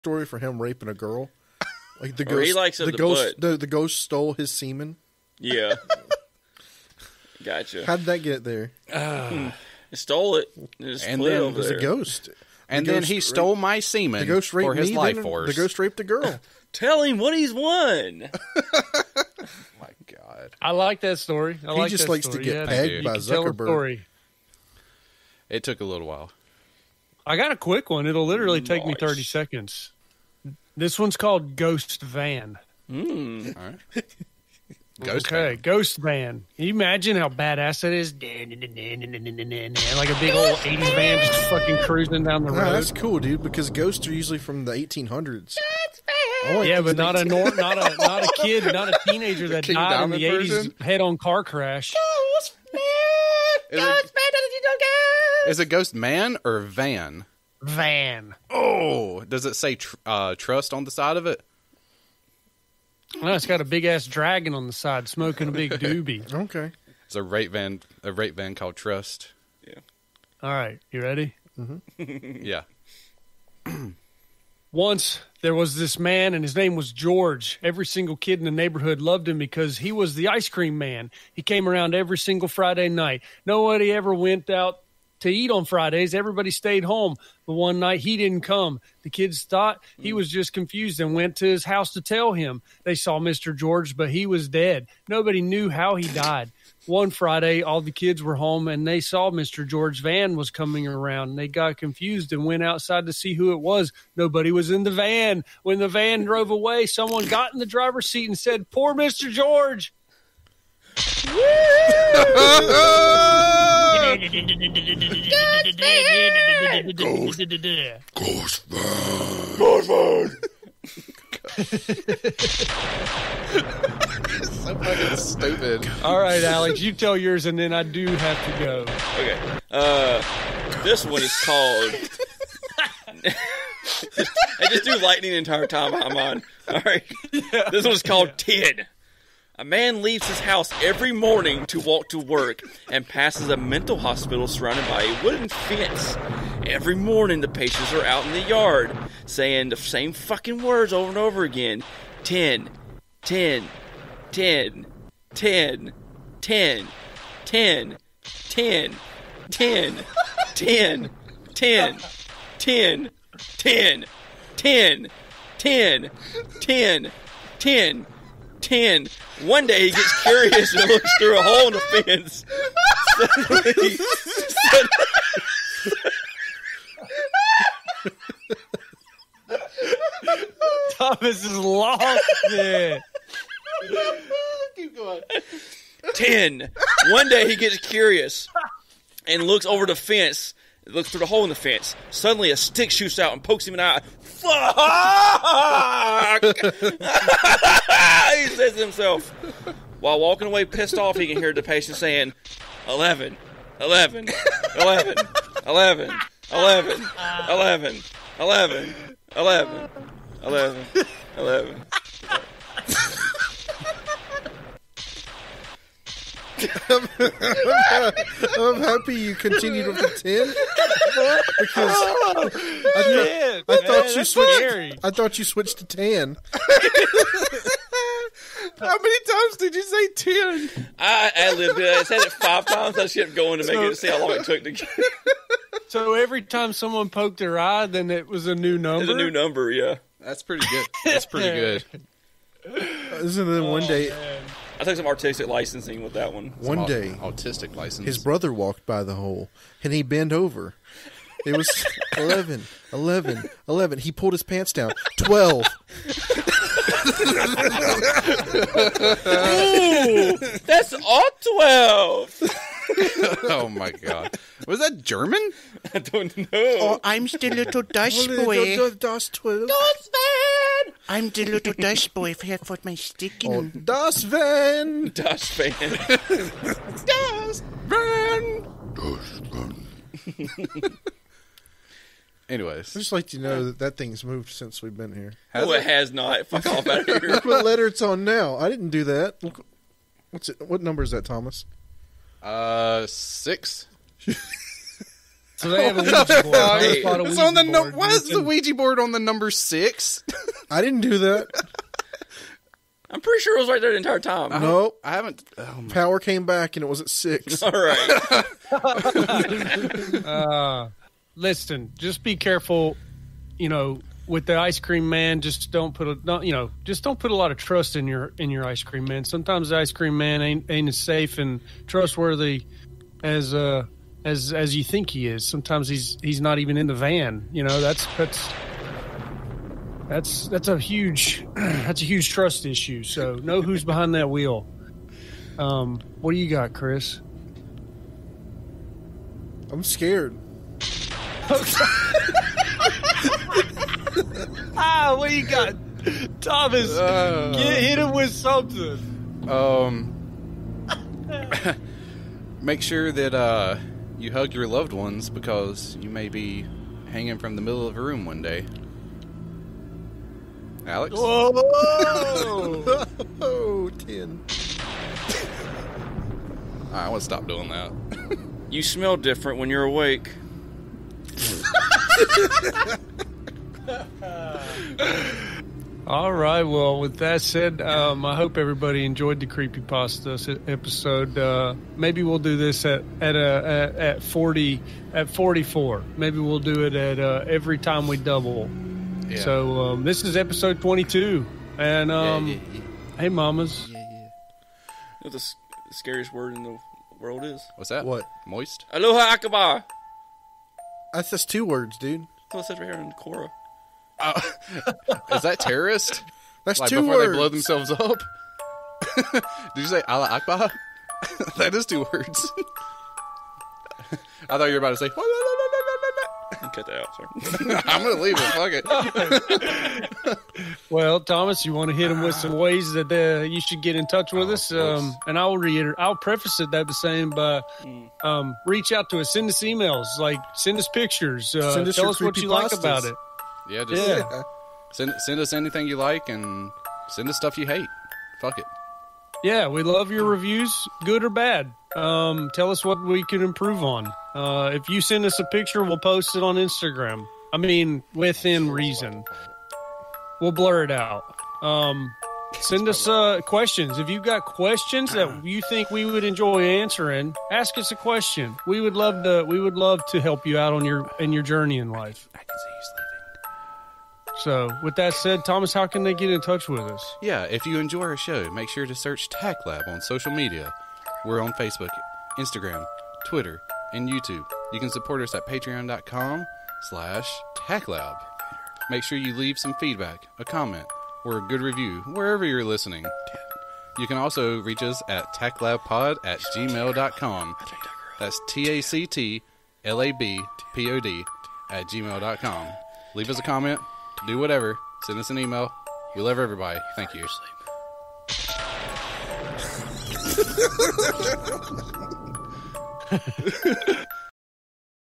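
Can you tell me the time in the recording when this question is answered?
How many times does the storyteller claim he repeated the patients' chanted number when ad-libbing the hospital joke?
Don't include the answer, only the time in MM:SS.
03:52.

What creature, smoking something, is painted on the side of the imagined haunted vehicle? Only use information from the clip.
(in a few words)
dragon.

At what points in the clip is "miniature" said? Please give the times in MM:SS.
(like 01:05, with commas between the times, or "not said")
not said.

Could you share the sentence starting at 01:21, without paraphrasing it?
He came around every single Friday night.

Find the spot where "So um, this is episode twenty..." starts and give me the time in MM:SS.
06:29.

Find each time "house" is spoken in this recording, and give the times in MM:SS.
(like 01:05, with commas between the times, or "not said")
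01:31, 02:20.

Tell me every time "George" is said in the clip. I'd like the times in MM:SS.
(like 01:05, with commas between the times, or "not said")
01:16, 01:33, 01:39, 01:49.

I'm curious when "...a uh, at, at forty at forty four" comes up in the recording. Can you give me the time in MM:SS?
06:23.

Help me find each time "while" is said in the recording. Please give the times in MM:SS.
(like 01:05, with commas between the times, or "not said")
00:26, 03:19.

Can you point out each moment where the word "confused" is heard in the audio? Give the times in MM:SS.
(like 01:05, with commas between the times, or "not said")
01:30, 01:41.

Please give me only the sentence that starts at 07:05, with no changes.
I'll preface it that by saying, mm.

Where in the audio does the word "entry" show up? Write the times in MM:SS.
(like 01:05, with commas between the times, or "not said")
not said.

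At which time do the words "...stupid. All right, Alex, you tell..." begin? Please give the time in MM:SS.
02:05.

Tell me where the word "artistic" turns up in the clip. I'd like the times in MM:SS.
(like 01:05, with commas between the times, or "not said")
04:05.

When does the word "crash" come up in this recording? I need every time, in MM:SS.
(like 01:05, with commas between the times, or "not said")
00:51.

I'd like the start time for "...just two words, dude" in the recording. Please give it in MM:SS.
06:41.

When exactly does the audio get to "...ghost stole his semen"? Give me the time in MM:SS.
00:03.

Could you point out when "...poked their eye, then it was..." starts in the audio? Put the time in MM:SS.
03:57.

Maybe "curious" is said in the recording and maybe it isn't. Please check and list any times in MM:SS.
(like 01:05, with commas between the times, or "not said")
02:50, 03:07.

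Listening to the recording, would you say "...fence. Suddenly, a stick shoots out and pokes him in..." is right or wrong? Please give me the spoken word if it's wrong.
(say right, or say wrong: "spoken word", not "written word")
right.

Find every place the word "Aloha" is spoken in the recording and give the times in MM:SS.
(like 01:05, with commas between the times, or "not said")
06:38.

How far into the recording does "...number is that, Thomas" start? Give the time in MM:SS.
04:50.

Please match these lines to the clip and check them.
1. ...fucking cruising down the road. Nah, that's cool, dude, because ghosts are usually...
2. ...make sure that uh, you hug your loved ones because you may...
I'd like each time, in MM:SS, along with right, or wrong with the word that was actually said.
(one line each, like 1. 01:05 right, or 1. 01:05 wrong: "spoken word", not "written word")
1. 00:41 right
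2. 05:52 right.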